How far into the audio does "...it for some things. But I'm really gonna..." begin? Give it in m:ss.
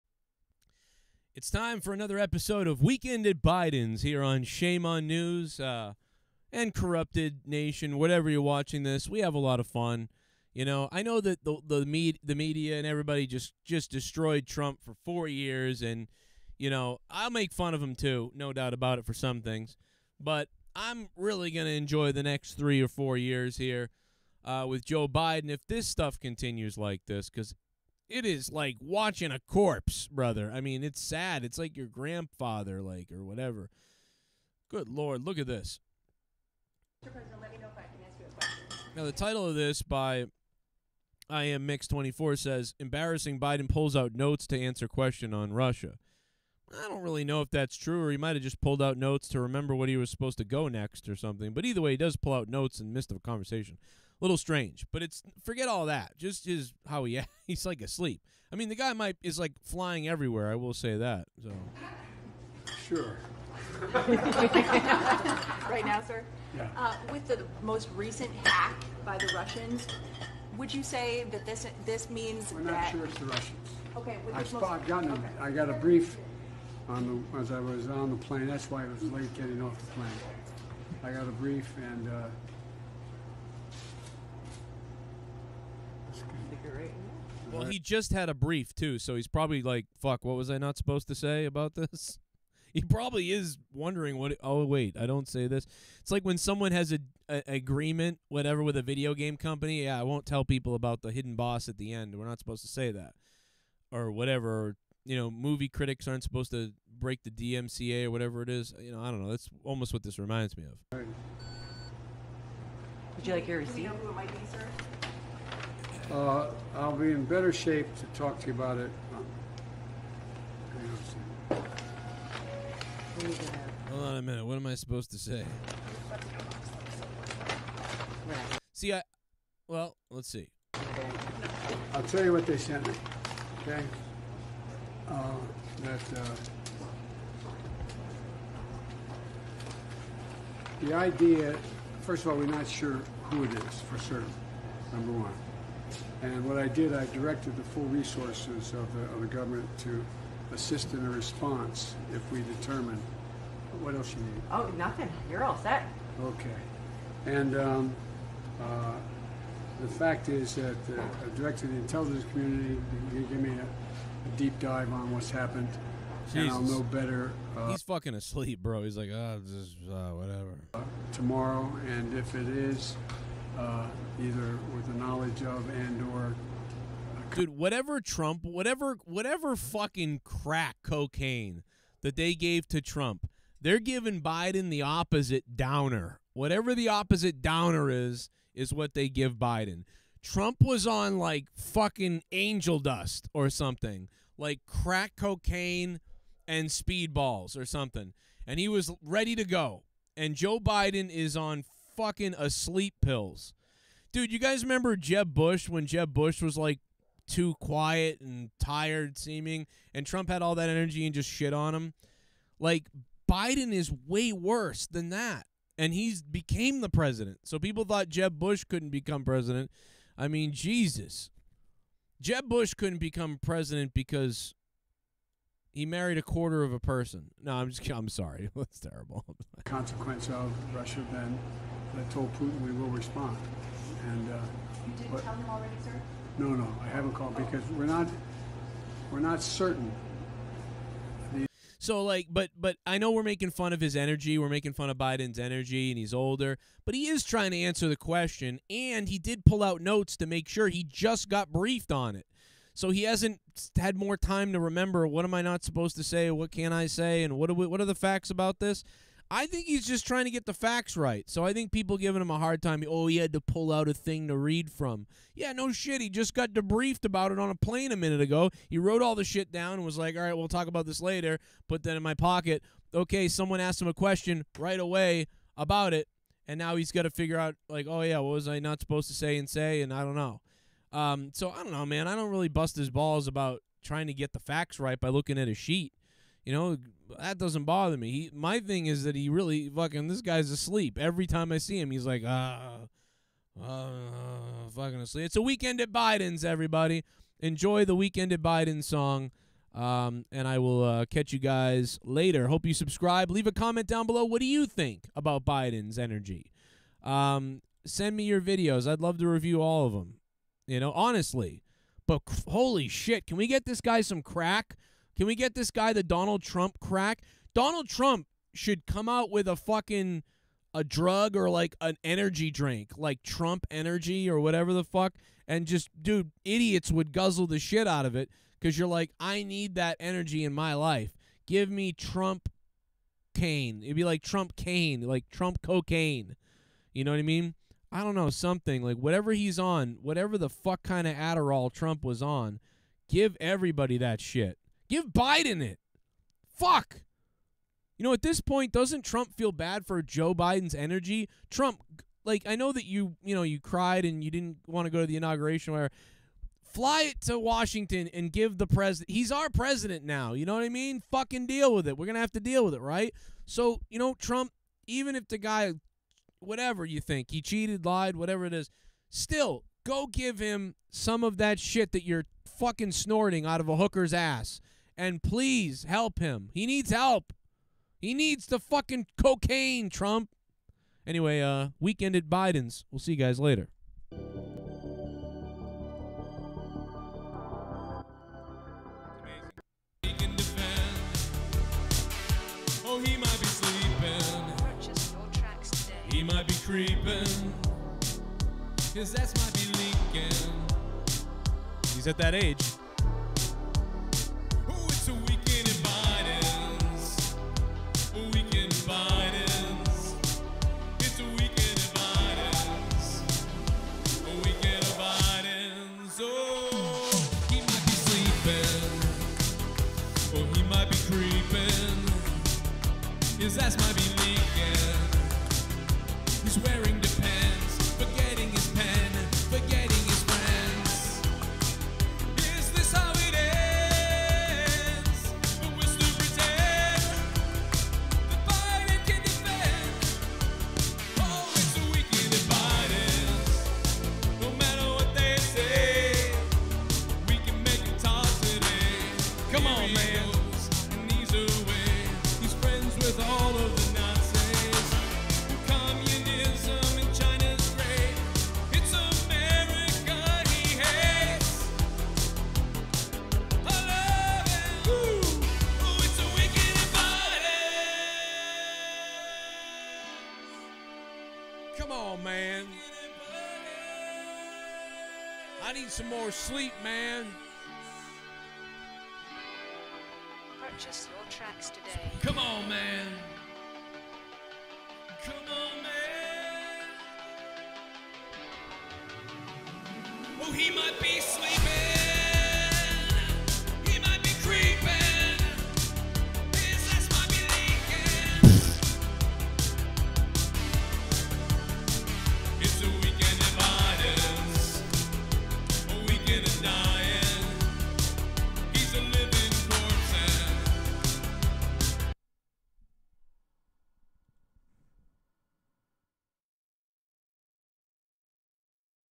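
0:18.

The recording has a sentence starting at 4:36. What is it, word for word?
And now he's got to figure out, like, oh, yeah, what was I not supposed to say and say?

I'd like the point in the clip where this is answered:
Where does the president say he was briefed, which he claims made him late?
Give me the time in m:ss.
1:17.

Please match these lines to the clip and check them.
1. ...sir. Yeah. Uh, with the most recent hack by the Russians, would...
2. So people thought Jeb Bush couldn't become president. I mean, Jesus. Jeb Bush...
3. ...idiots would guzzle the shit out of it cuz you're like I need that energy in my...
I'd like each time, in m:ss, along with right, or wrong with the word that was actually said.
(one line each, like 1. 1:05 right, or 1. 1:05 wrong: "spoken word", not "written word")
1. 1:06 right
2. 3:37 right
3. 5:26 right.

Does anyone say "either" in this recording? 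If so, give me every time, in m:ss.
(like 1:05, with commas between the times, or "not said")
0:51, 2:54.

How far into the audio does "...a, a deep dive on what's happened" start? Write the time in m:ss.
2:43.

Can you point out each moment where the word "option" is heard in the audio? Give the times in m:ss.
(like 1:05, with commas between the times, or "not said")
not said.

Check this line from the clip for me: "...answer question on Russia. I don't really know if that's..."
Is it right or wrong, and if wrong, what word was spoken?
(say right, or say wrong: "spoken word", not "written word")
right.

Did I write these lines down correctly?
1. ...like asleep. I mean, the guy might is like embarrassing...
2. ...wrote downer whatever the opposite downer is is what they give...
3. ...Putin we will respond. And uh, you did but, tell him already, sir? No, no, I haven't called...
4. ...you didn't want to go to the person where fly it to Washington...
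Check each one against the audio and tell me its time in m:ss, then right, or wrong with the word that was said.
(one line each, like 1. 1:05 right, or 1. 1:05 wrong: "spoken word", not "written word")
1. 0:57 wrong: "flying", not "embarrassing"
2. 3:04 wrong: "opposite", not "wrote"
3. 3:52 right
4. 5:54 wrong: "inauguration", not "person".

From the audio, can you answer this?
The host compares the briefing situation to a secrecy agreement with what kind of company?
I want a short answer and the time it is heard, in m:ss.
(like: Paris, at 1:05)
A video game company, at 1:38.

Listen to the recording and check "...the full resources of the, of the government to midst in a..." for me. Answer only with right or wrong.
wrong.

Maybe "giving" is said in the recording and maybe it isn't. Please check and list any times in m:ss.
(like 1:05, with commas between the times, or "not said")
3:03, 4:21.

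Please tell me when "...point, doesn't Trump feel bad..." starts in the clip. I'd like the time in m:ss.
5:48.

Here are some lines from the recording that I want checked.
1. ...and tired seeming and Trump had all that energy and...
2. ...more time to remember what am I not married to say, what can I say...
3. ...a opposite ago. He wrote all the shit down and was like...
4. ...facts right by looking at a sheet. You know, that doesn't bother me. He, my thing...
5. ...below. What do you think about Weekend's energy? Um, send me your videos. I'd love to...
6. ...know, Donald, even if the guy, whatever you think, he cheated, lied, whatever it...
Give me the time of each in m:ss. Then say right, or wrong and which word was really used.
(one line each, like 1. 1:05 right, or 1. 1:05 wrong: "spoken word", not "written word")
1. 3:28 right
2. 4:13 wrong: "supposed", not "married"
3. 4:27 wrong: "minute", not "opposite"
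4. 4:44 right
5. 5:04 wrong: "Biden", not "Weekend"
6. 6:03 wrong: "Trump", not "Donald".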